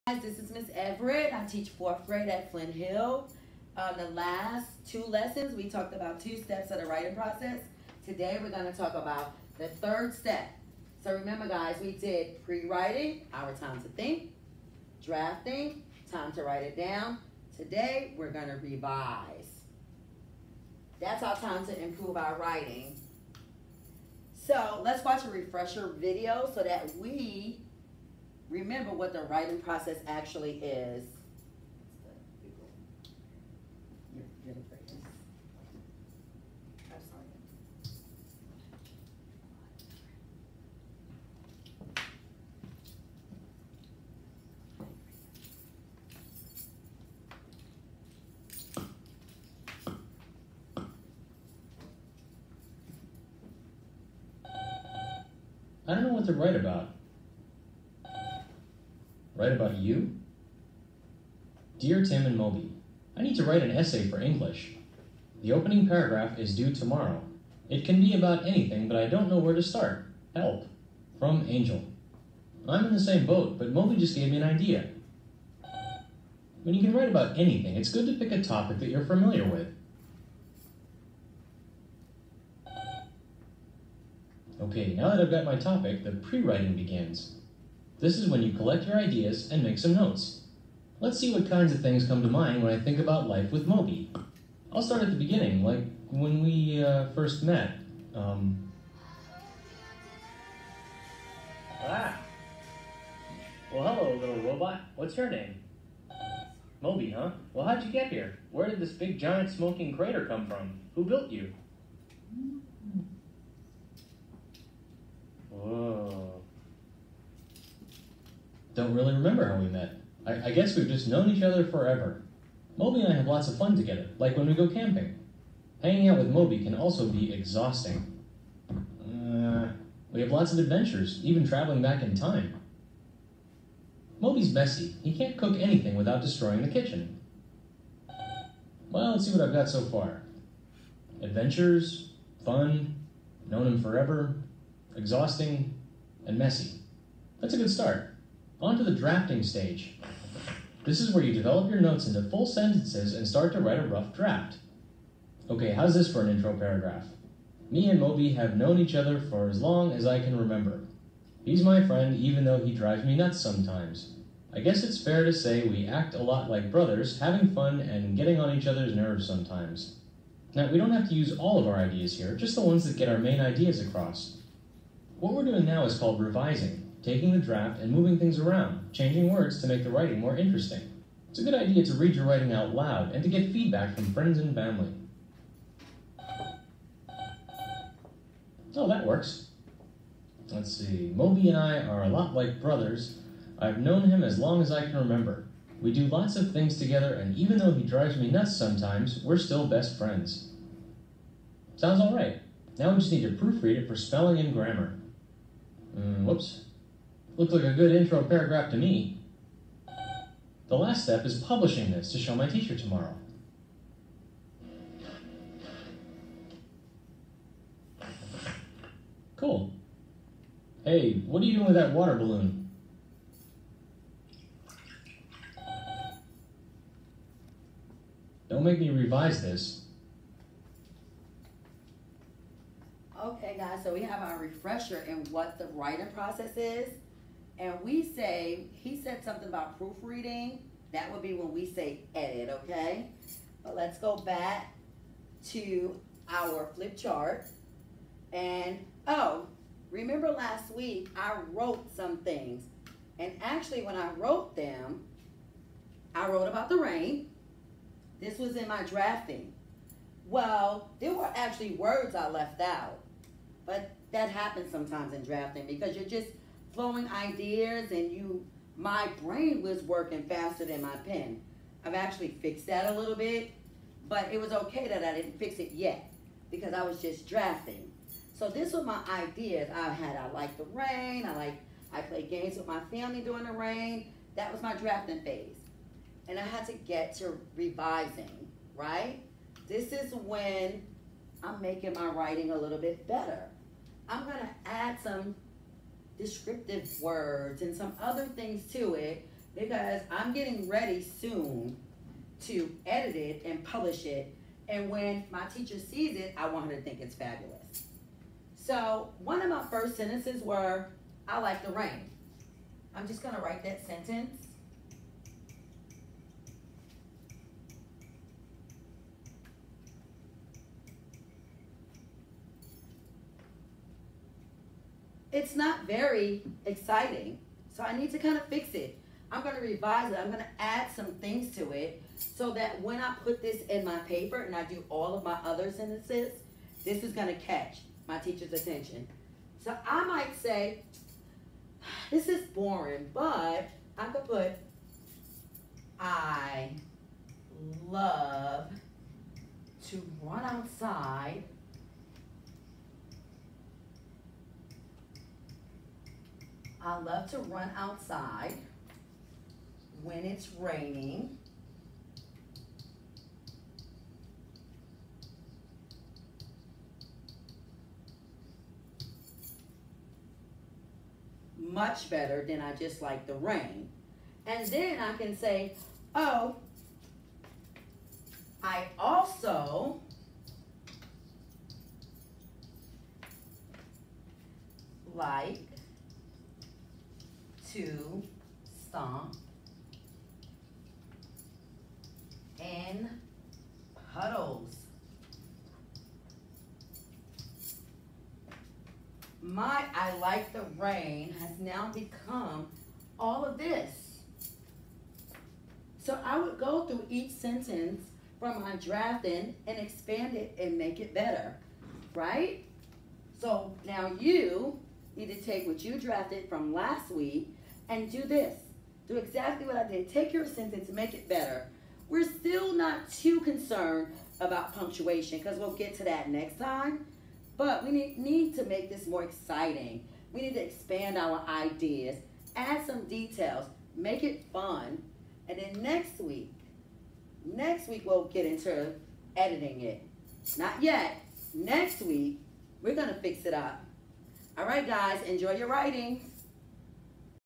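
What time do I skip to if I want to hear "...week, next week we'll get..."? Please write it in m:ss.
7:16.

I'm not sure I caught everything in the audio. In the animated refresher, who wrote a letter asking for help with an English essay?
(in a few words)
Angel.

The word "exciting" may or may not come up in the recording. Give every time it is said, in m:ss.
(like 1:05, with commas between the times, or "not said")
5:26, 7:09.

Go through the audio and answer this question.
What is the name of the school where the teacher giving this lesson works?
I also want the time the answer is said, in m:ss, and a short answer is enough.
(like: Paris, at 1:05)
Flint Hill, at 0:02.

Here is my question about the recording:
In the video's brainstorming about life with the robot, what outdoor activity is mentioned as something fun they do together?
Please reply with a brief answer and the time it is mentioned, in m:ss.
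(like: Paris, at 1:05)
camping, at 2:04.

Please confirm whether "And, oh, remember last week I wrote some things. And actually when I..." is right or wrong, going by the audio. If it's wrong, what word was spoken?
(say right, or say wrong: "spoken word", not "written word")
right.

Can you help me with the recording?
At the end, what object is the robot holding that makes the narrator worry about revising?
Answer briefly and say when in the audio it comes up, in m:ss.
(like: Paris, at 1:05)
water balloon, at 3:41.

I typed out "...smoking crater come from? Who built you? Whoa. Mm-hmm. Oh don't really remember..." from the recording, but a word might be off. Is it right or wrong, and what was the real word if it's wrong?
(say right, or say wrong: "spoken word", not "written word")
right.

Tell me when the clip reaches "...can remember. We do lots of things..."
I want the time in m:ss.
3:14.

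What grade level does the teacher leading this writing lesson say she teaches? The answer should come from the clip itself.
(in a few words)
fourth grade.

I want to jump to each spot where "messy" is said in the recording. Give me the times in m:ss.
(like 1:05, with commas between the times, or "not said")
2:14, 2:26.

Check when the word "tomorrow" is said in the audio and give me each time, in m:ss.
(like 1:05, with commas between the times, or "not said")
1:06, 3:32.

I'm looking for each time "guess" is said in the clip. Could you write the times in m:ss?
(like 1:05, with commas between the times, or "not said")
2:00, 2:44.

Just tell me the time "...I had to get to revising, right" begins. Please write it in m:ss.
4:46.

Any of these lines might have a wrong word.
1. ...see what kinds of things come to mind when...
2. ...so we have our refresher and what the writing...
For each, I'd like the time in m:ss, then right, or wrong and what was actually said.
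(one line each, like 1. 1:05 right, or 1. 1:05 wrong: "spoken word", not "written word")
1. 1:31 right
2. 3:53 right.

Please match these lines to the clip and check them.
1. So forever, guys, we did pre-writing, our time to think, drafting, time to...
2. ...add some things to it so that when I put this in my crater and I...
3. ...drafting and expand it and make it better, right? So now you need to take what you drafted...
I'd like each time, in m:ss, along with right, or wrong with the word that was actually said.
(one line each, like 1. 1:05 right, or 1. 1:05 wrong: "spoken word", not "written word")
1. 0:11 wrong: "remember", not "forever"
2. 5:30 wrong: "paper", not "crater"
3. 6:48 right.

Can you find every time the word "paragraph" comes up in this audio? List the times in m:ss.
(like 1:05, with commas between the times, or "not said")
1:05, 2:36, 3:28.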